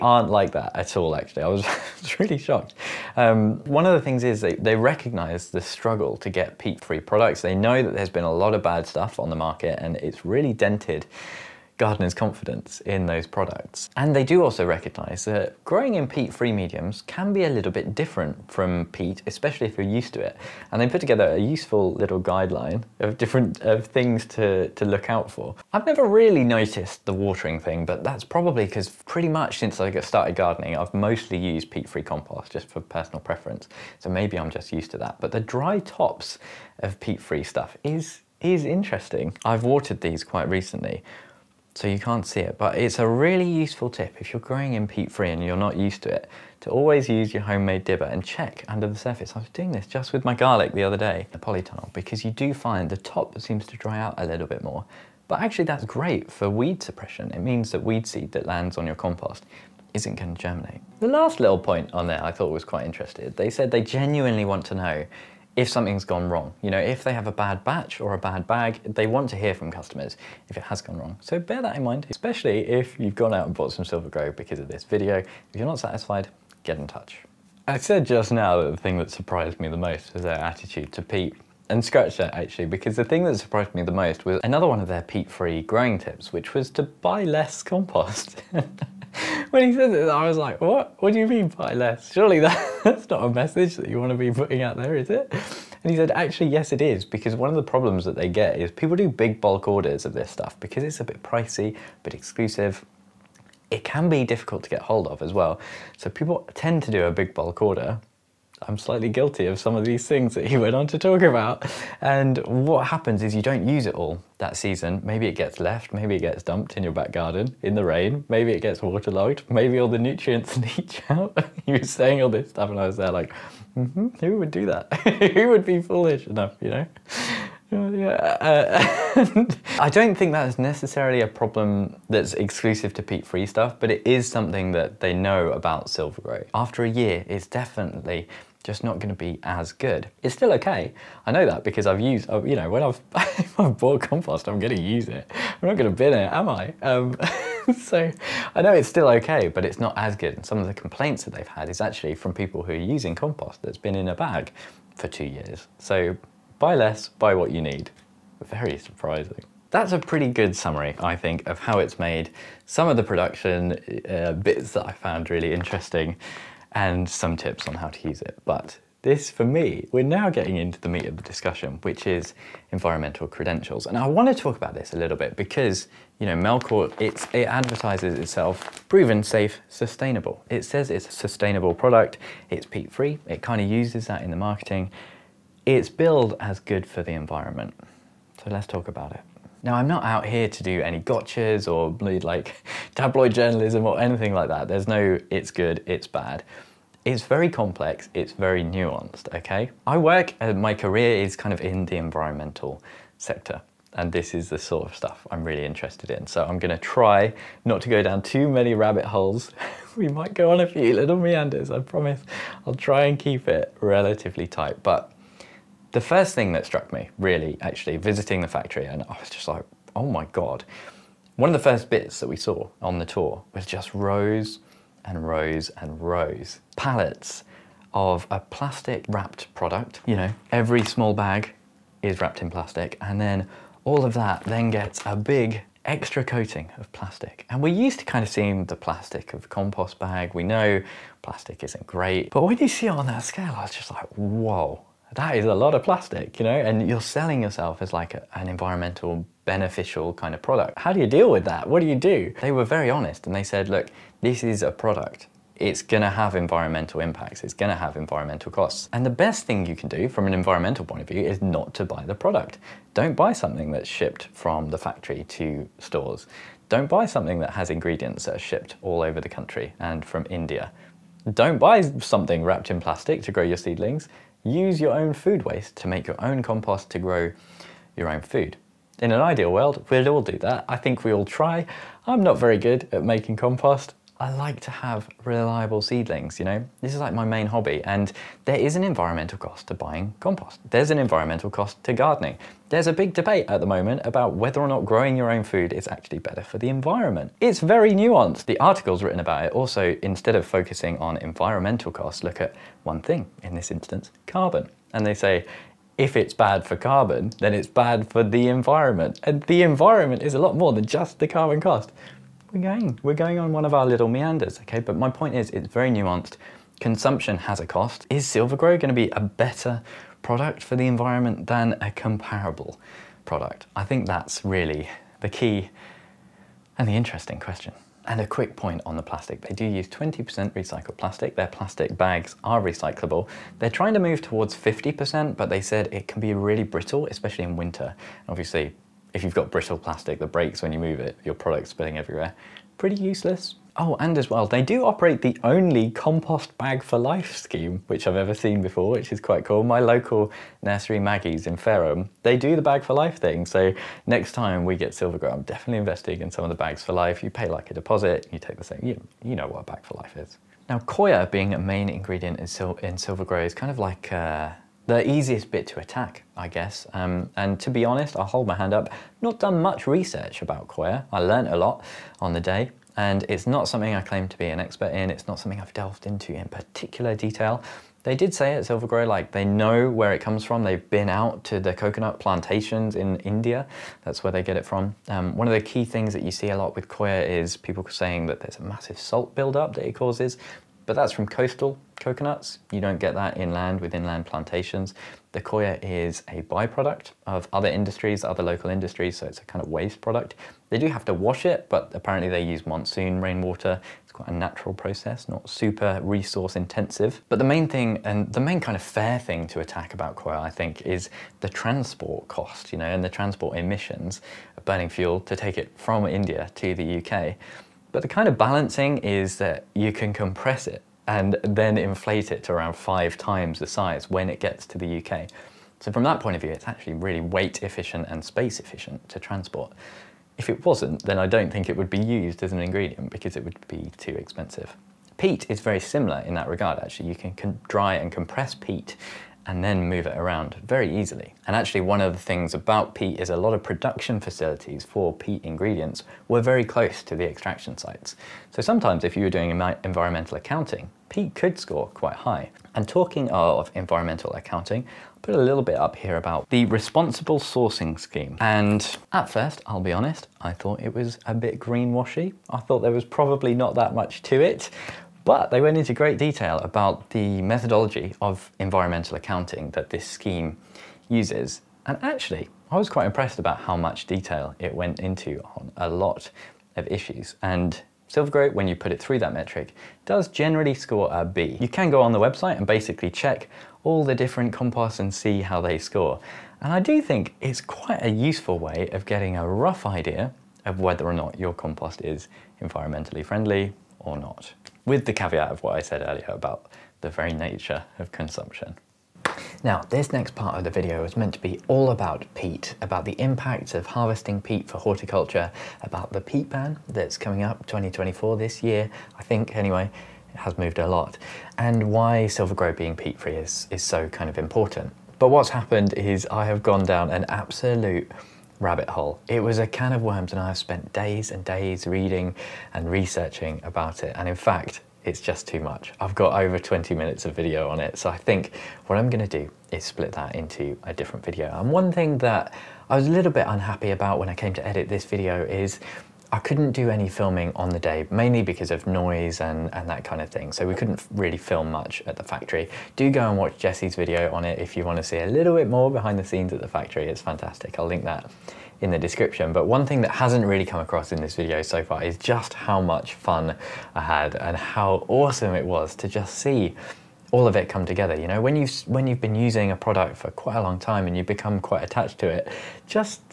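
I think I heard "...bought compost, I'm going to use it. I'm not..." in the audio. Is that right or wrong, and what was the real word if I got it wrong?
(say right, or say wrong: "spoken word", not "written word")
right.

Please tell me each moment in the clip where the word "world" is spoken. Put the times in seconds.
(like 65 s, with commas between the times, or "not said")
279 s.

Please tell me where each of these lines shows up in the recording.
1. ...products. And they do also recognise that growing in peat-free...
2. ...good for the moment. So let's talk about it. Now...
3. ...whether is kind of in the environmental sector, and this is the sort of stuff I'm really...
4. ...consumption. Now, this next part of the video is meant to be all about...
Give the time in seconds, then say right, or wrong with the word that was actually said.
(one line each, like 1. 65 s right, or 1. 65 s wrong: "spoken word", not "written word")
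1. 13 s right
2. 186 s wrong: "environment", not "moment"
3. 200 s wrong: "career", not "whether"
4. 498 s right.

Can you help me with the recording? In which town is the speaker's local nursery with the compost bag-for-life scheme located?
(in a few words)
Fareham.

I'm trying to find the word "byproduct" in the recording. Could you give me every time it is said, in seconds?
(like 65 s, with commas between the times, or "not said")
396 s.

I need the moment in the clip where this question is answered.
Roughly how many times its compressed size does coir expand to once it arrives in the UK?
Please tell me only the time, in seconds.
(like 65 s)
422 s.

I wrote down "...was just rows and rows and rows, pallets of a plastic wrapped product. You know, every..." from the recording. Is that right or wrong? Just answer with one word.
right.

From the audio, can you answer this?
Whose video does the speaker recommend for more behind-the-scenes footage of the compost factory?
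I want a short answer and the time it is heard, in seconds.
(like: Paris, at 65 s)
Jesse's, at 543 s.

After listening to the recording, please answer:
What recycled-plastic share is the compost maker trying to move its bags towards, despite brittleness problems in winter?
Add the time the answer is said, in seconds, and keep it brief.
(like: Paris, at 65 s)
50%, at 334 s.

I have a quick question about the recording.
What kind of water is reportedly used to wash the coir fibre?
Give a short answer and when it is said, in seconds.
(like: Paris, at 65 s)
monsoon rainwater, at 402 s.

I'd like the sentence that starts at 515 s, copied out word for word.
But what's happened is I have gone down an absolute rabbit hole.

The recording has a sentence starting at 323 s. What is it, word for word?
I think that's really the key and the interesting question.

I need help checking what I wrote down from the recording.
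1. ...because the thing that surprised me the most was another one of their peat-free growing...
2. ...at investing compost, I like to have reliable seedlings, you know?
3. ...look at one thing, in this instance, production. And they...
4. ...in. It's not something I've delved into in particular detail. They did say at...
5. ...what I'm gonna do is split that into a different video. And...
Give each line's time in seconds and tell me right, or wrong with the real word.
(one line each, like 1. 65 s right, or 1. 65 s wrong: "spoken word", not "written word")
1. 82 s right
2. 282 s wrong: "making", not "investing"
3. 302 s wrong: "carbon", not "production"
4. 374 s right
5. 528 s right.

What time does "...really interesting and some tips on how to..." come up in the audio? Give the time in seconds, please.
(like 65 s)
165 s.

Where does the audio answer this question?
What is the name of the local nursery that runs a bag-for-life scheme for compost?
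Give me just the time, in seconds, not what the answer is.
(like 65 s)
350 s.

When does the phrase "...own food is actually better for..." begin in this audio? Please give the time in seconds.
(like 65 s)
295 s.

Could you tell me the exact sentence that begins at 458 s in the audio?
And at first, I'll be honest, I thought it was a bit greenwashy.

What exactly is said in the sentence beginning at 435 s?
Peat is very similar in that regard, actually.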